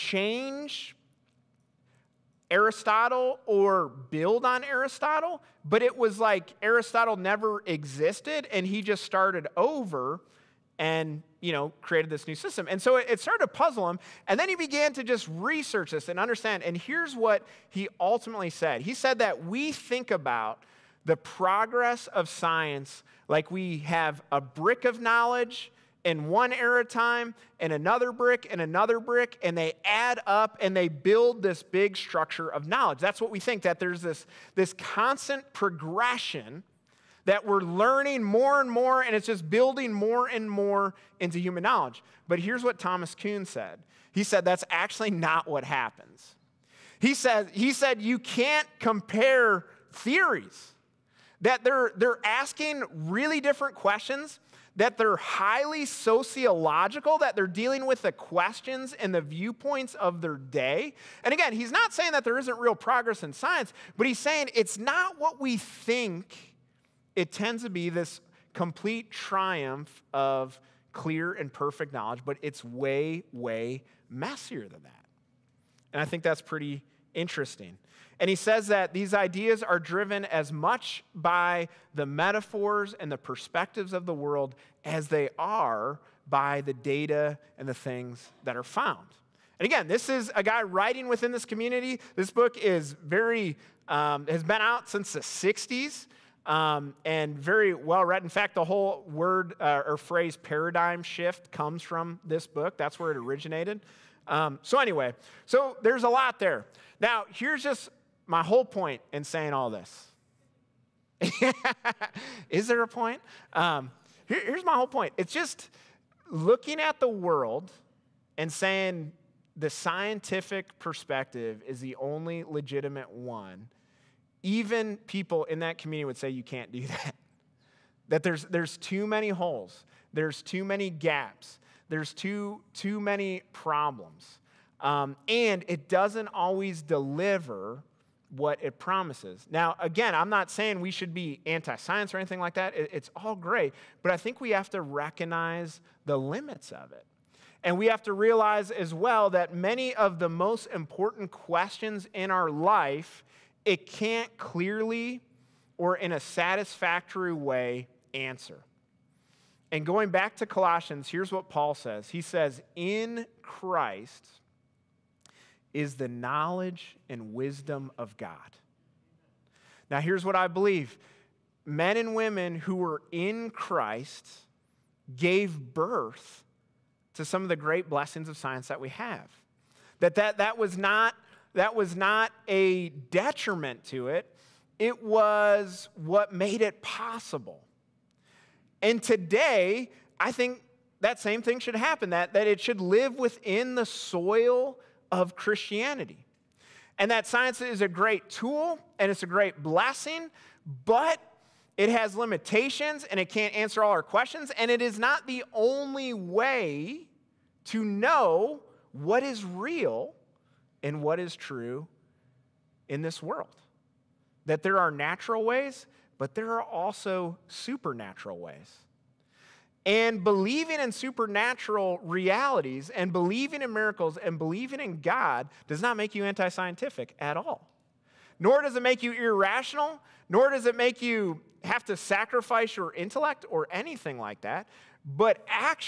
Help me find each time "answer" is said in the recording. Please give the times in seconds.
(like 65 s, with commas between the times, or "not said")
158 s, 203 s.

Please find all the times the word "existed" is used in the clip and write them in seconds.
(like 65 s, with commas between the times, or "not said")
7 s.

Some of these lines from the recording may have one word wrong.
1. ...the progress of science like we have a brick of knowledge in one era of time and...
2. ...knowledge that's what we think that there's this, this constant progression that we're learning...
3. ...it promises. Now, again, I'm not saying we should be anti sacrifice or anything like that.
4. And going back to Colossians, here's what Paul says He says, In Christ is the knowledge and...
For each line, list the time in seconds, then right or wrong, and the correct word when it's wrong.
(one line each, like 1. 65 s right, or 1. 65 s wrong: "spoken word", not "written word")
1. 21 s right
2. 32 s right
3. 138 s wrong: "science", not "sacrifice"
4. 159 s right.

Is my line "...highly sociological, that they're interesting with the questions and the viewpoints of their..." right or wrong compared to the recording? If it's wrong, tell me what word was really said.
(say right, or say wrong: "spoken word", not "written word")
wrong: "dealing", not "interesting".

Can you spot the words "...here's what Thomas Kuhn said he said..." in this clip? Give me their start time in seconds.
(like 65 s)
42 s.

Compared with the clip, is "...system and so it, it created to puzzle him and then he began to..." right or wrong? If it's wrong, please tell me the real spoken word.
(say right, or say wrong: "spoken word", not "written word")
wrong: "started", not "created".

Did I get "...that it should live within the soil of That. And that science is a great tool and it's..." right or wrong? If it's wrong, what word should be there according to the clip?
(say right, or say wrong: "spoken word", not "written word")
wrong: "Christianity", not "That".